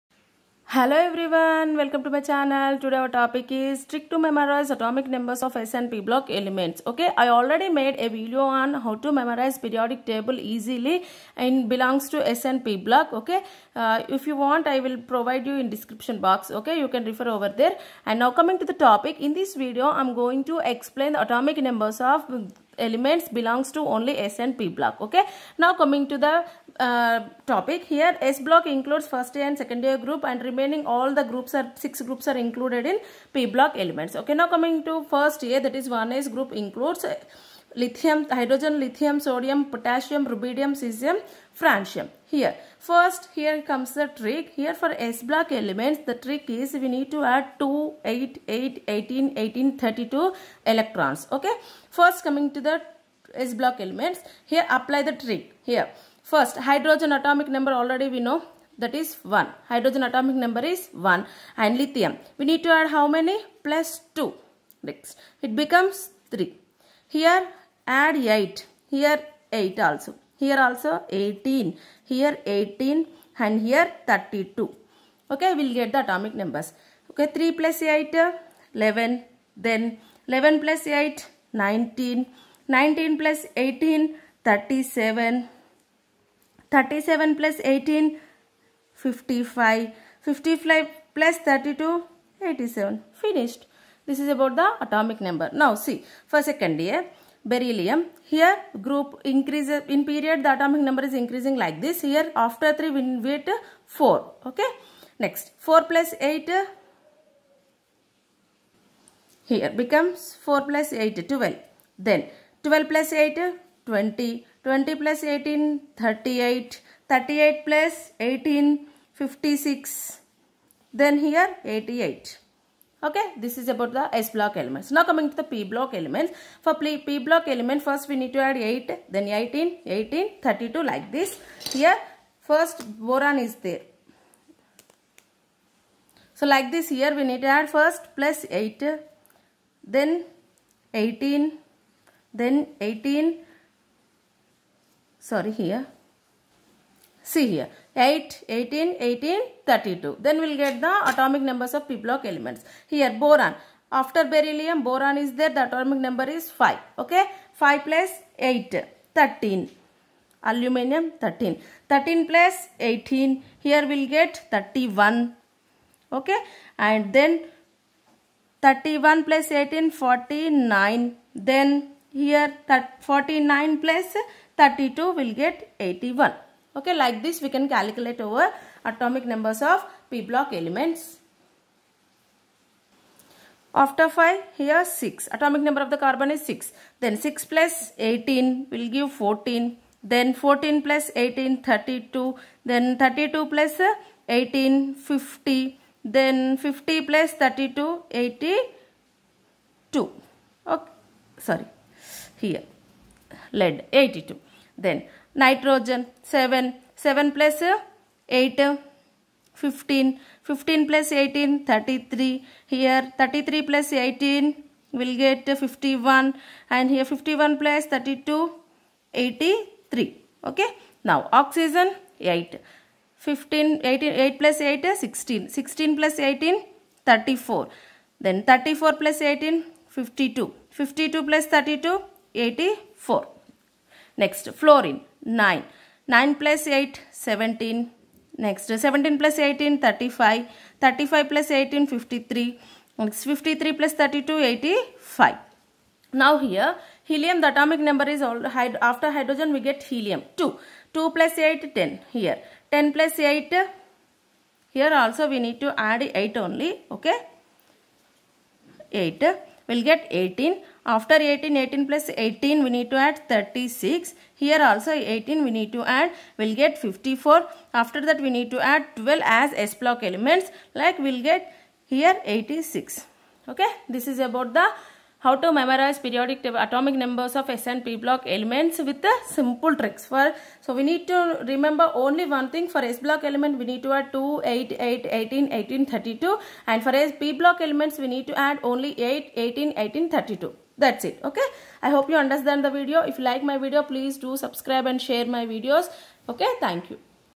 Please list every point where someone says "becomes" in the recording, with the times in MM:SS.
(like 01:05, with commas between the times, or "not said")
01:05, 01:49.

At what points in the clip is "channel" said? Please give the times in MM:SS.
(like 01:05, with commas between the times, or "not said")
00:02.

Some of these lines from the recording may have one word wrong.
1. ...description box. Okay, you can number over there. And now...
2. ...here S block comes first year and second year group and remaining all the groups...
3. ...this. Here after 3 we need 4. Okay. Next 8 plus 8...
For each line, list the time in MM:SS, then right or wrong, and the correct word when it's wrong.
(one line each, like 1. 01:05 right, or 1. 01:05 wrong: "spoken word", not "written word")
1. 00:15 wrong: "refer", not "number"
2. 00:27 wrong: "includes", not "comes"
3. 01:41 wrong: "4", not "8".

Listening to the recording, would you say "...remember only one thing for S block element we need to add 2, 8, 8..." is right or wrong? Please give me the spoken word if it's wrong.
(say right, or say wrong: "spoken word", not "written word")
right.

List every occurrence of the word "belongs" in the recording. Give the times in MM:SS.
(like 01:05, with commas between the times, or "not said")
00:11, 00:23.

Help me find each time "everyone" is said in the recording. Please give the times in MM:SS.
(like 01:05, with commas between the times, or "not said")
00:01.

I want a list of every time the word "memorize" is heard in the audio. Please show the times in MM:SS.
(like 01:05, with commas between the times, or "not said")
00:04, 00:09, 04:35.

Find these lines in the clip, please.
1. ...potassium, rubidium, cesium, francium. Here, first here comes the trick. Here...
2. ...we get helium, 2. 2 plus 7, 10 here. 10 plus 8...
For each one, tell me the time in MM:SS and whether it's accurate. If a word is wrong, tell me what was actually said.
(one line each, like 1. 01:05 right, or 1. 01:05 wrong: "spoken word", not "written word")
1. 00:39 right
2. 04:09 wrong: "8", not "7".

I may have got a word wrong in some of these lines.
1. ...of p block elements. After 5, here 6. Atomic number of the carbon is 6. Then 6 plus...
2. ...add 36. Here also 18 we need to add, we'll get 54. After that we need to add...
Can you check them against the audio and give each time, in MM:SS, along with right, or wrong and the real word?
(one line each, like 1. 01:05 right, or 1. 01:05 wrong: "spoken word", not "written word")
1. 02:59 right
2. 04:22 right.